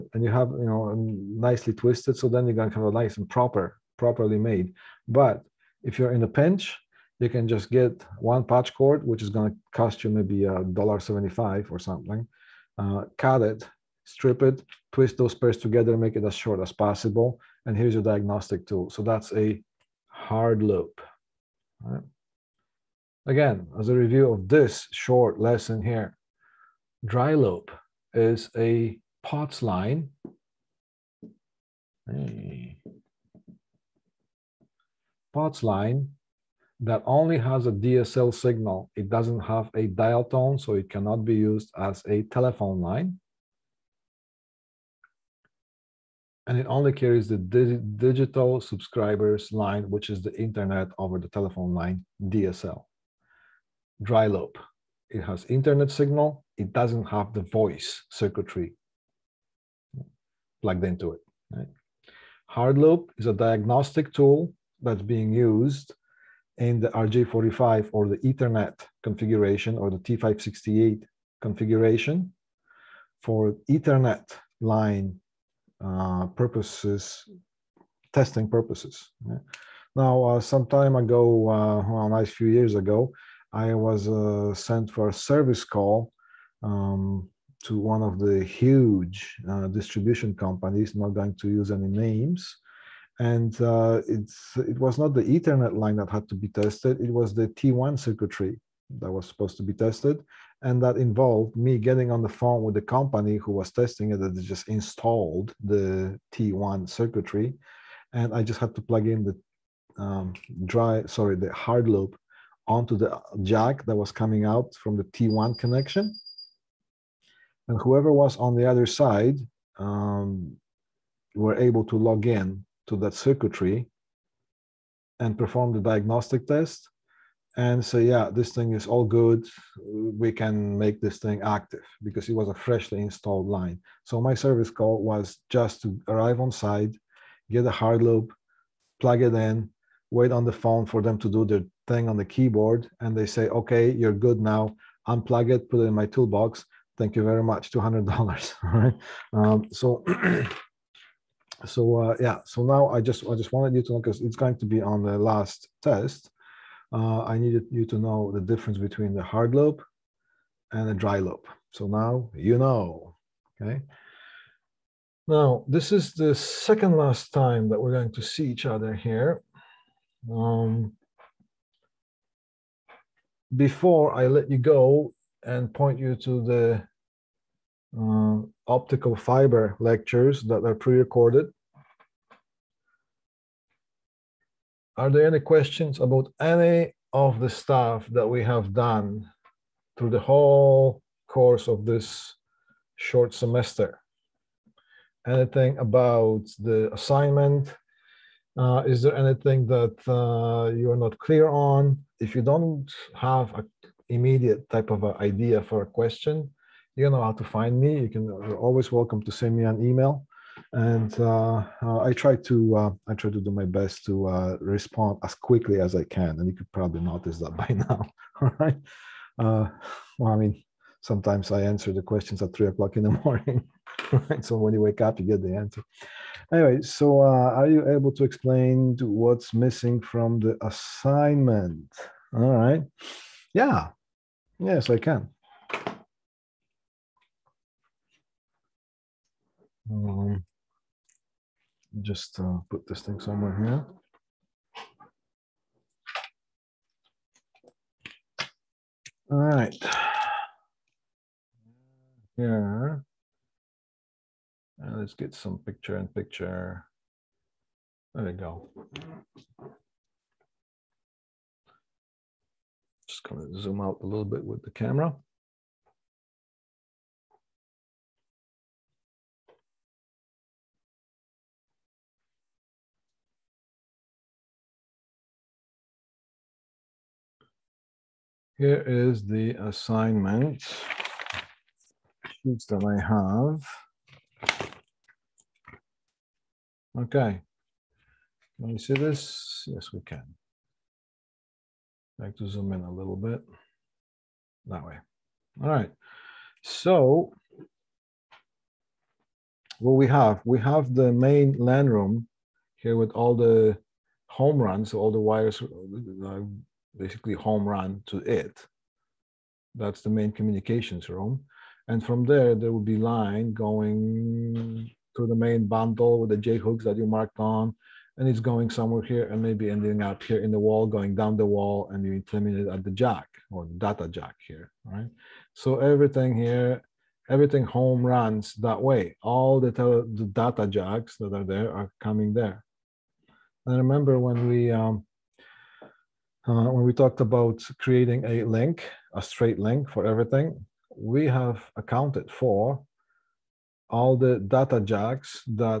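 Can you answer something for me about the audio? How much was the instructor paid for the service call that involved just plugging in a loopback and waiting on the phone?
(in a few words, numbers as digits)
$200.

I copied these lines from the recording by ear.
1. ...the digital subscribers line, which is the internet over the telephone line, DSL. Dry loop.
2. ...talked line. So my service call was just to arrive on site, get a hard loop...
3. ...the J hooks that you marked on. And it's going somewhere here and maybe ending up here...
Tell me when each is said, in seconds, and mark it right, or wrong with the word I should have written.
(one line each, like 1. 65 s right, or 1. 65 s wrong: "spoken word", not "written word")
1. 47 s right
2. 133 s wrong: "installed", not "talked"
3. 316 s right.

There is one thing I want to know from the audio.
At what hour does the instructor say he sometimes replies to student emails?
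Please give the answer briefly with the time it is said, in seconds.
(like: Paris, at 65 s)
3 a.m., at 222 s.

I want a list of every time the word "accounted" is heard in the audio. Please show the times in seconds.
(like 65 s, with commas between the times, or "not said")
341 s.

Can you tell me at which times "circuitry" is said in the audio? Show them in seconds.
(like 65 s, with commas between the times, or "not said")
58 s, 97 s, 106 s, 123 s.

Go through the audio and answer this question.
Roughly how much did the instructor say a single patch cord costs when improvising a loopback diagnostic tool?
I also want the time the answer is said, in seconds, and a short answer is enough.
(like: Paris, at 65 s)
$1.75, at 10 s.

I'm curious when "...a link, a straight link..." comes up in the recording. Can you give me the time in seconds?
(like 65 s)
338 s.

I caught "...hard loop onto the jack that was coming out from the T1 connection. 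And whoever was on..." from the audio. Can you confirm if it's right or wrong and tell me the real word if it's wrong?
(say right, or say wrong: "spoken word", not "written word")
right.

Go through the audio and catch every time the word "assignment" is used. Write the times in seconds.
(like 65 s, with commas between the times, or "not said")
196 s, 230 s, 279 s.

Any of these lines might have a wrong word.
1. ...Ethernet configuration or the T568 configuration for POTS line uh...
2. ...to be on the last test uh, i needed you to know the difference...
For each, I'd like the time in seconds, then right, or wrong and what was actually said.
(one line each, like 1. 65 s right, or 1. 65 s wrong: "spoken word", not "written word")
1. 68 s wrong: "Ethernet", not "POTS"
2. 154 s right.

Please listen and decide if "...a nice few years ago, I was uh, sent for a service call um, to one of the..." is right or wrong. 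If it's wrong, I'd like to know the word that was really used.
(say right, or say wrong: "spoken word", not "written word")
right.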